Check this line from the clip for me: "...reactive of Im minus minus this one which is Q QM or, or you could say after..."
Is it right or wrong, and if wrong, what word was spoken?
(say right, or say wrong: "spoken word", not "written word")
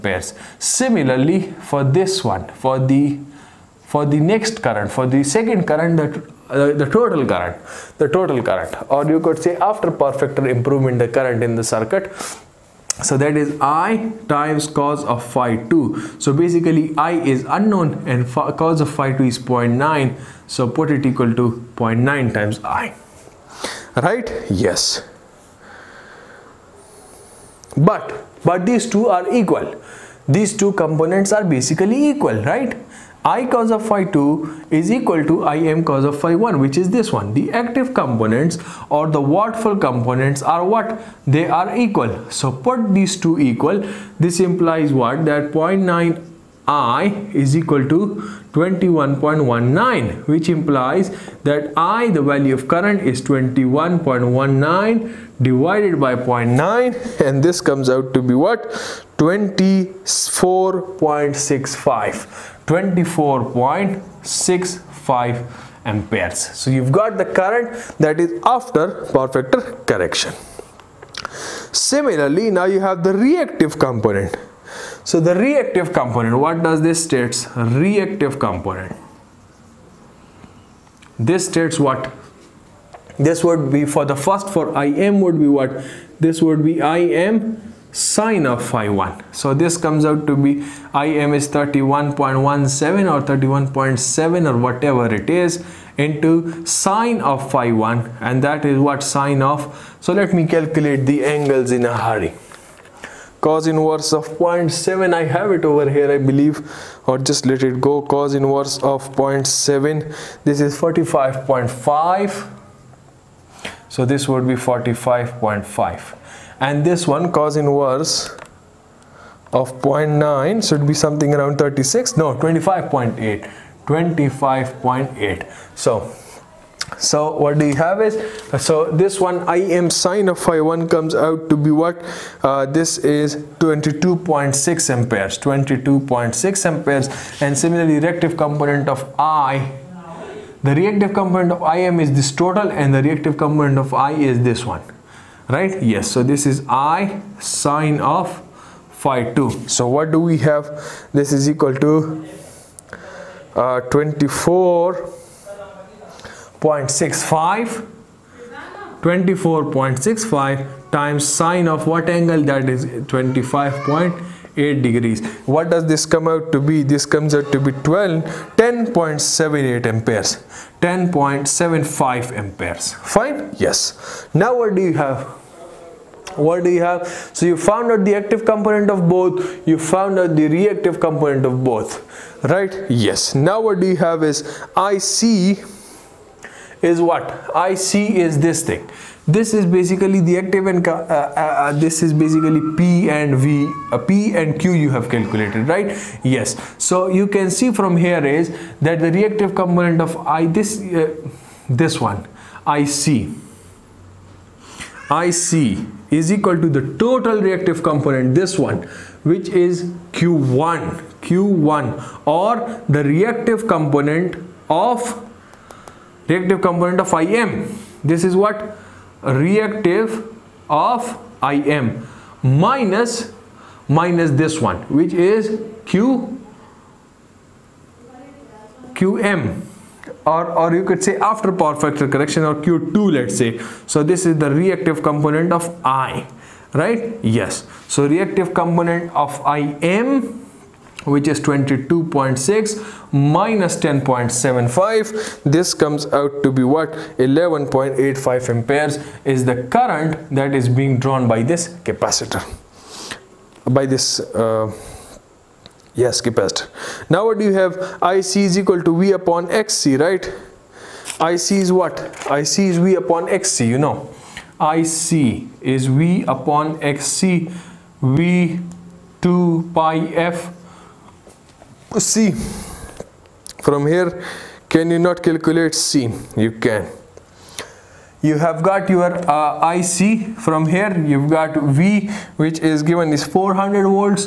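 right.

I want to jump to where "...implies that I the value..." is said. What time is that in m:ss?
0:50.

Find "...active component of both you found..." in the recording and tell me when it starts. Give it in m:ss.
2:58.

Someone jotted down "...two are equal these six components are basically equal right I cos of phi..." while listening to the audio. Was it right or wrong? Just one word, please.
wrong.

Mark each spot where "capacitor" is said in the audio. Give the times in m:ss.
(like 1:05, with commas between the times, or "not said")
4:11, 4:16.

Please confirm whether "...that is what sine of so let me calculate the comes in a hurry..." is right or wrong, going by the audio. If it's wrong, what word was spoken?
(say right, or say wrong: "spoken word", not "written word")
wrong: "angles", not "comes".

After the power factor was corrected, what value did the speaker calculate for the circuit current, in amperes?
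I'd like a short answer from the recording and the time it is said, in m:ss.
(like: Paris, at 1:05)
24.65 amperes, at 1:02.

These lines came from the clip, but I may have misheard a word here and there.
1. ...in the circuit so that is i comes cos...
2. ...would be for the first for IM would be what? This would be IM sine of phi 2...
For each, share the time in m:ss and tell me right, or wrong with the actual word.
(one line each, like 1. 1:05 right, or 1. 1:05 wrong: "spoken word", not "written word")
1. 0:11 wrong: "times", not "comes"
2. 1:23 wrong: "1", not "2".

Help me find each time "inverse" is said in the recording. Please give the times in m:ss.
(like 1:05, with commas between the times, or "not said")
1:43, 1:48, 1:57.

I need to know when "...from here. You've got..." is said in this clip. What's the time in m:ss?
4:40.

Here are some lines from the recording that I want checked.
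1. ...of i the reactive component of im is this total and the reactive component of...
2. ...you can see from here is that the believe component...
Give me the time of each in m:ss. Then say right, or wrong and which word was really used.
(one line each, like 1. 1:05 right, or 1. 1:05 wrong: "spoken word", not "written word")
1. 2:18 right
2. 3:17 wrong: "reactive", not "believe".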